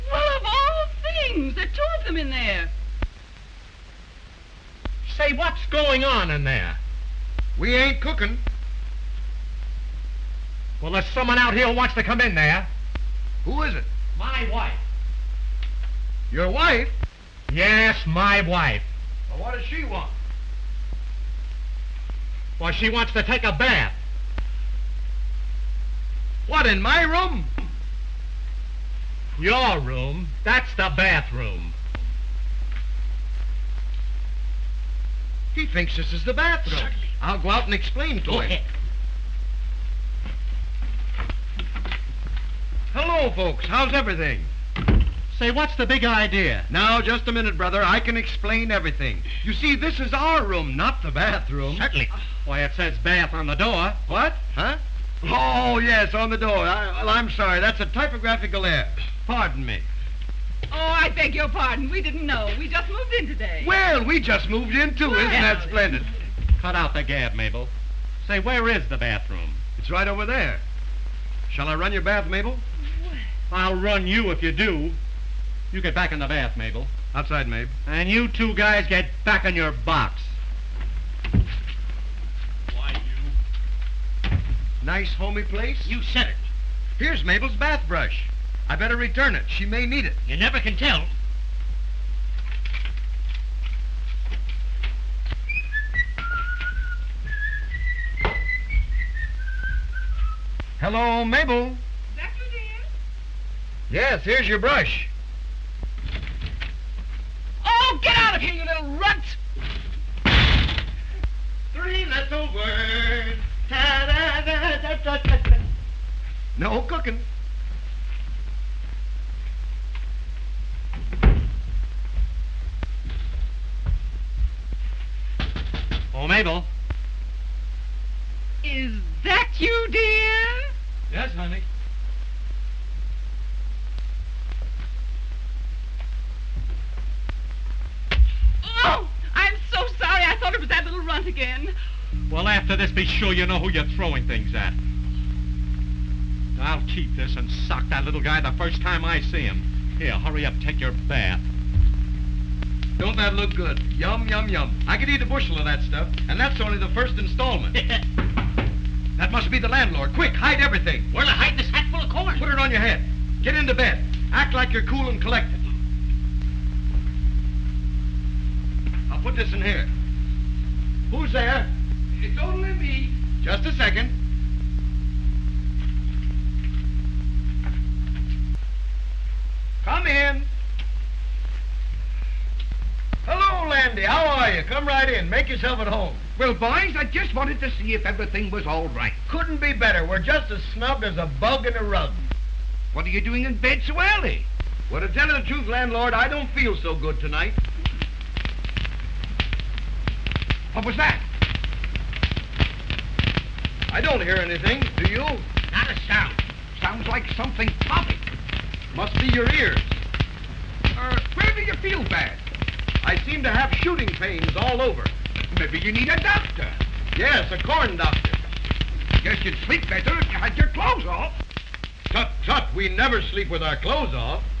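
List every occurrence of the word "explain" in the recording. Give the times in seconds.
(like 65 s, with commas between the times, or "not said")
37 s, 48 s.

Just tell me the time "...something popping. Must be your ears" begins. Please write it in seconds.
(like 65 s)
207 s.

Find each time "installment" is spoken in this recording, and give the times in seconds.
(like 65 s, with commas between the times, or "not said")
157 s.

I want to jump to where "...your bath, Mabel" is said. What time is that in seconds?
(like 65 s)
71 s.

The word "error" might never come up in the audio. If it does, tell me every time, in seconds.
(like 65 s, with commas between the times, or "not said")
58 s.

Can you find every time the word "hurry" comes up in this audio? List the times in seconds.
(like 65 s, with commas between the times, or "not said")
150 s.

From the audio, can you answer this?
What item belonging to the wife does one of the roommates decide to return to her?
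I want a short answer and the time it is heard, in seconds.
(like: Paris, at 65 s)
Bath brush, at 86 s.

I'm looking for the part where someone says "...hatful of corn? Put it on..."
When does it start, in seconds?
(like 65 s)
161 s.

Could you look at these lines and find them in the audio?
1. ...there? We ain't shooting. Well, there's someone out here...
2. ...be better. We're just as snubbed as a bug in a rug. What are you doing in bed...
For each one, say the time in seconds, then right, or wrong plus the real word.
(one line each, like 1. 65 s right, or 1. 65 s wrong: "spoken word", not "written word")
1. 6 s wrong: "cooking", not "shooting"
2. 189 s right.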